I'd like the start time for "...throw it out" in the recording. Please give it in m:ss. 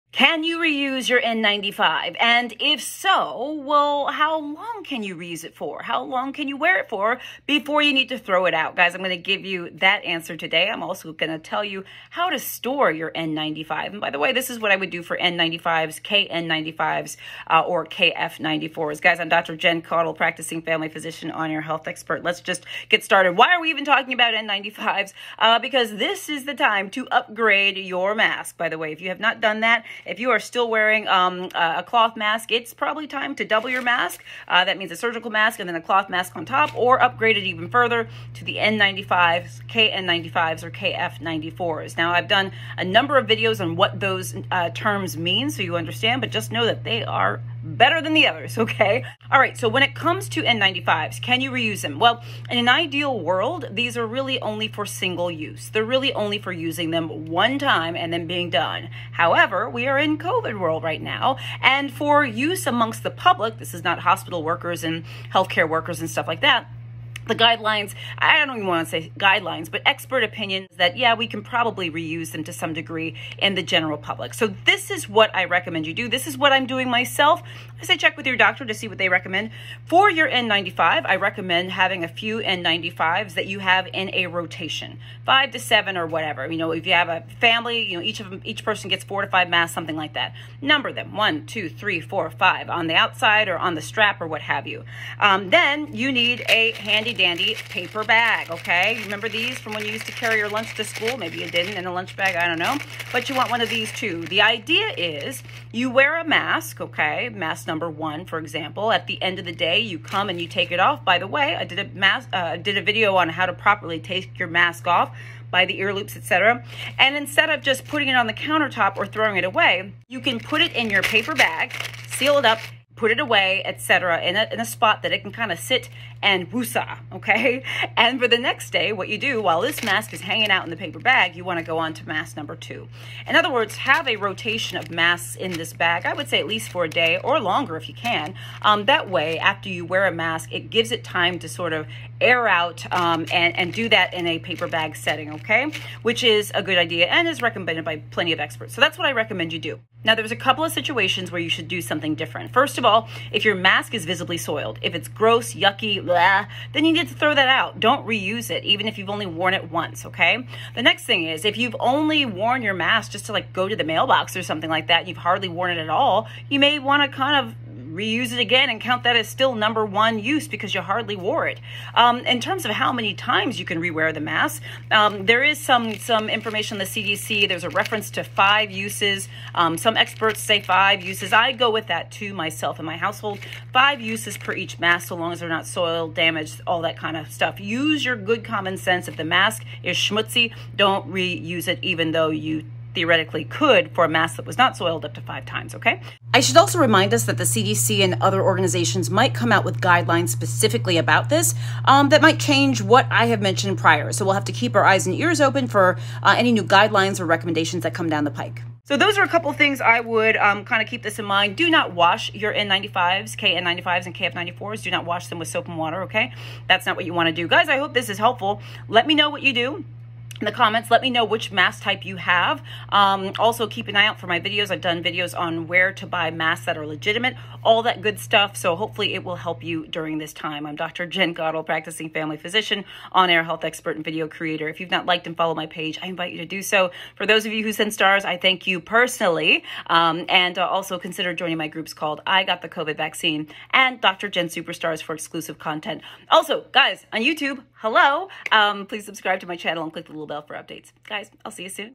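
0:08.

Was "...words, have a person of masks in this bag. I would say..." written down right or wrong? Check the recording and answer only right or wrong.
wrong.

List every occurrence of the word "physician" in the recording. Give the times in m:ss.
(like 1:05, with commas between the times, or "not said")
0:20, 3:52.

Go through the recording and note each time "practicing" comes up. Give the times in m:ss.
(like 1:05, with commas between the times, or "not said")
0:20, 3:51.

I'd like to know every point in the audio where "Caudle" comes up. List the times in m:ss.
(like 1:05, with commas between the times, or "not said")
0:19, 3:51.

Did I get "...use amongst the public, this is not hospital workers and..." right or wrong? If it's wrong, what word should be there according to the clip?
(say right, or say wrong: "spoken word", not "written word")
right.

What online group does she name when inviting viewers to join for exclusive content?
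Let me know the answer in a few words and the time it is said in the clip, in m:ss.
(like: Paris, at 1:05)
I Got the COVID Vaccine, at 4:02.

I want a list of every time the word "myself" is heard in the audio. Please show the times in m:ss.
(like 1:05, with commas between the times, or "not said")
1:16, 3:02.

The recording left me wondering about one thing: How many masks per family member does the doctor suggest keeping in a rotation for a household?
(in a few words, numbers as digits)
4 to 5.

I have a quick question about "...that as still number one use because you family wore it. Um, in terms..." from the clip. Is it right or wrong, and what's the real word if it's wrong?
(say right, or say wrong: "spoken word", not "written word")
wrong: "hardly", not "family".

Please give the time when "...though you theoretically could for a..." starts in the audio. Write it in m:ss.
3:12.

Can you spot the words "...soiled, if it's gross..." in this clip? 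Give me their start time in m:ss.
2:34.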